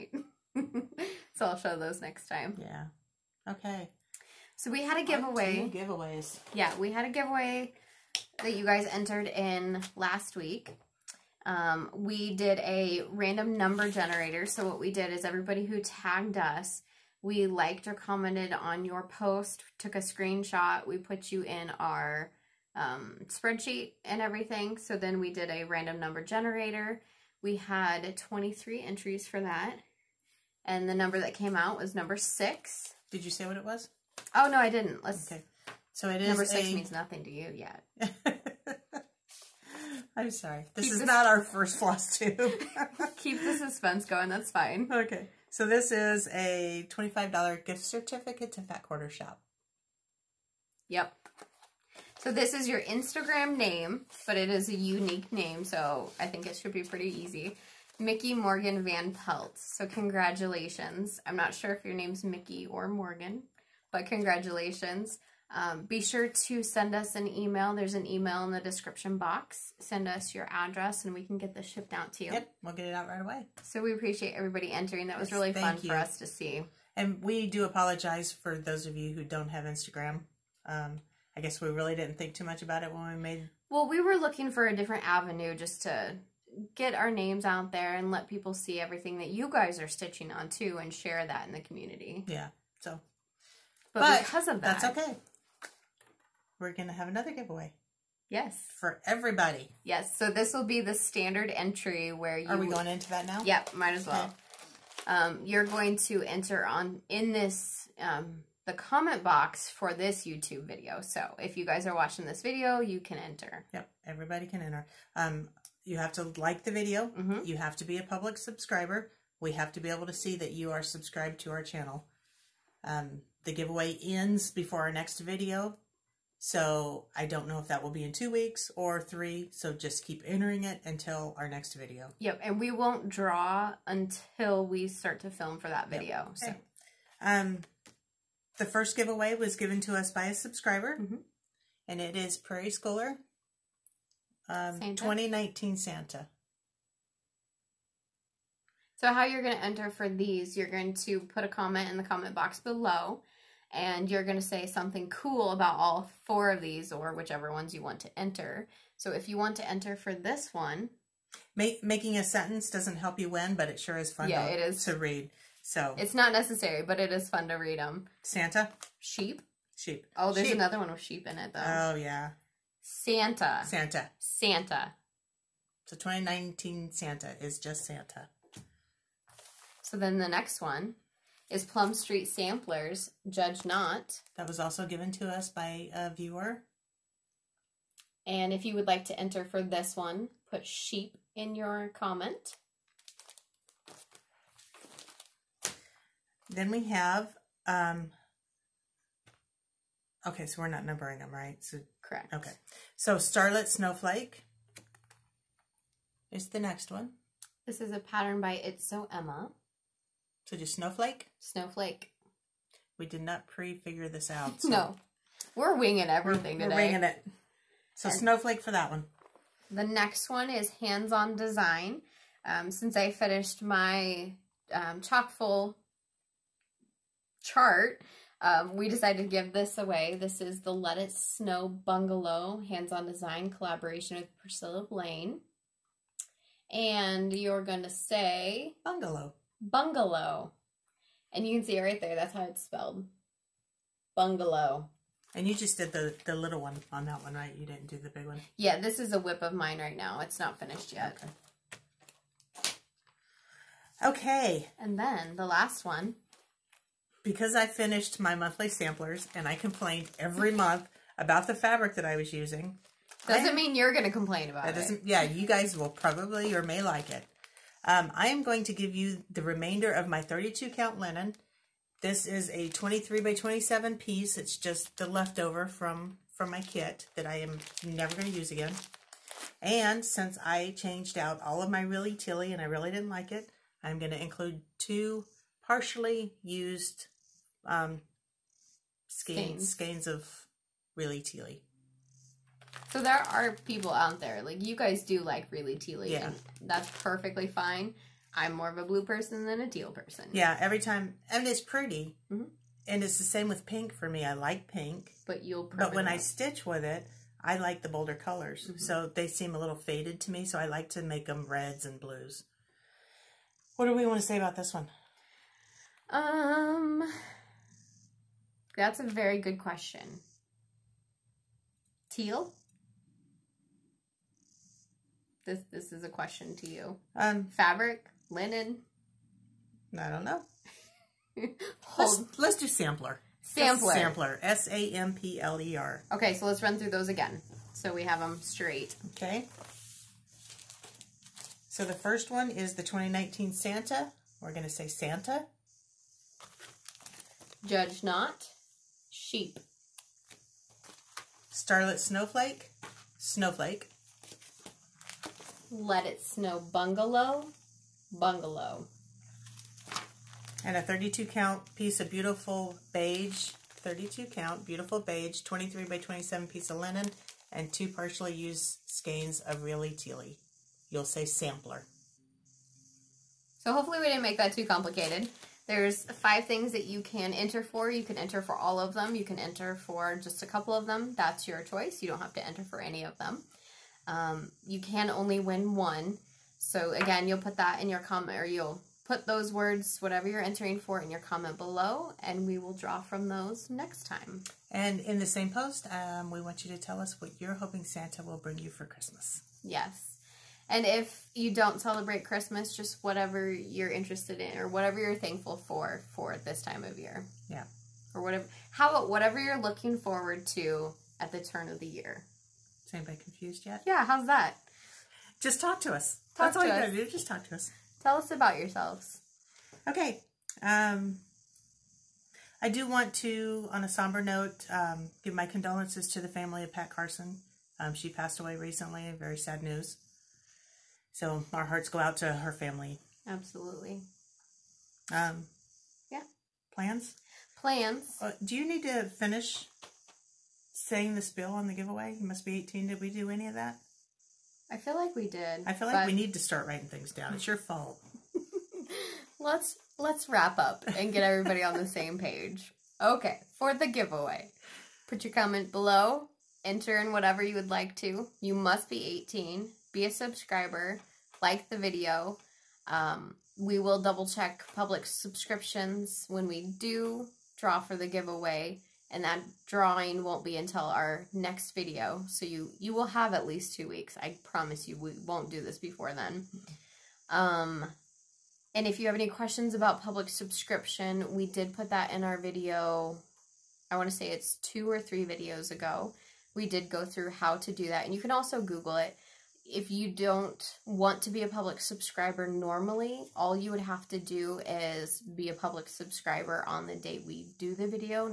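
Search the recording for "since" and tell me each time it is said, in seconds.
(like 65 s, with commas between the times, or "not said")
222 s, 280 s.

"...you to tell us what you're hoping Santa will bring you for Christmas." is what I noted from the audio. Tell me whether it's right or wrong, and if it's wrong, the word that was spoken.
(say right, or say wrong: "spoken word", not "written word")
right.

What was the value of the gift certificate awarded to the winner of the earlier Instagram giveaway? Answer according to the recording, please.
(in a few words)
$25.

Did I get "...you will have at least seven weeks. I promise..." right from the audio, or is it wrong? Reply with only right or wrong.
wrong.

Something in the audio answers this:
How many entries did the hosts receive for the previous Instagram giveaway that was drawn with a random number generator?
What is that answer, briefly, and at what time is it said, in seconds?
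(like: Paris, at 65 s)
23, at 28 s.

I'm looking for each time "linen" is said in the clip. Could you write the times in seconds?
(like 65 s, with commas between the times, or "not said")
270 s, 328 s, 366 s.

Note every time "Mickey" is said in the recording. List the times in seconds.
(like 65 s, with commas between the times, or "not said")
57 s, 62 s.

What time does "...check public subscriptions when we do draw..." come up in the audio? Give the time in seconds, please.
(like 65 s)
464 s.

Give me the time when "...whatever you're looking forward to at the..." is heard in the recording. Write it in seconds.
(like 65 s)
409 s.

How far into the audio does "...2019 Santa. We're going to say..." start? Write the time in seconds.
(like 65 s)
342 s.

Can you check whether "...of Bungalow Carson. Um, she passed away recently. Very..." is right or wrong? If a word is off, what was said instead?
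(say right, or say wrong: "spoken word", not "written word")
wrong: "Pat", not "Bungalow".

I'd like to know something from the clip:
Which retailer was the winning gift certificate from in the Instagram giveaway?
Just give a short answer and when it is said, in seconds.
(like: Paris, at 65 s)
Fat Quarter Shop, at 48 s.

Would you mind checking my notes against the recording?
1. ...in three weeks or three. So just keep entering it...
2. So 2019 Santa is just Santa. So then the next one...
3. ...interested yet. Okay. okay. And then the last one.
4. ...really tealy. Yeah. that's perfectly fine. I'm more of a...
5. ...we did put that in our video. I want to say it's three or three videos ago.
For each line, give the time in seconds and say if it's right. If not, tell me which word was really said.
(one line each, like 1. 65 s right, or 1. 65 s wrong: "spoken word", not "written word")
1. 128 s wrong: "two", not "three"
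2. 175 s right
3. 250 s wrong: "finished", not "interested"
4. 295 s right
5. 481 s wrong: "two", not "three".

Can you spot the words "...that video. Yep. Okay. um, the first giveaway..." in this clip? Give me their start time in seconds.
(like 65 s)
135 s.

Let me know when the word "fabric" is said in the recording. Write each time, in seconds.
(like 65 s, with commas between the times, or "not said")
261 s, 327 s.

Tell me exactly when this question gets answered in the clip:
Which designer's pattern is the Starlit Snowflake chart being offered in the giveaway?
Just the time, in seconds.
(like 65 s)
208 s.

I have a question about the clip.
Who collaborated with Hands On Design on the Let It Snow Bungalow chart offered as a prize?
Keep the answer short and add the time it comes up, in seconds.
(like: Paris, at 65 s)
Priscilla Blaine, at 234 s.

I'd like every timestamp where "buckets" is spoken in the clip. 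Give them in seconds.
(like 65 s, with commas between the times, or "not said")
not said.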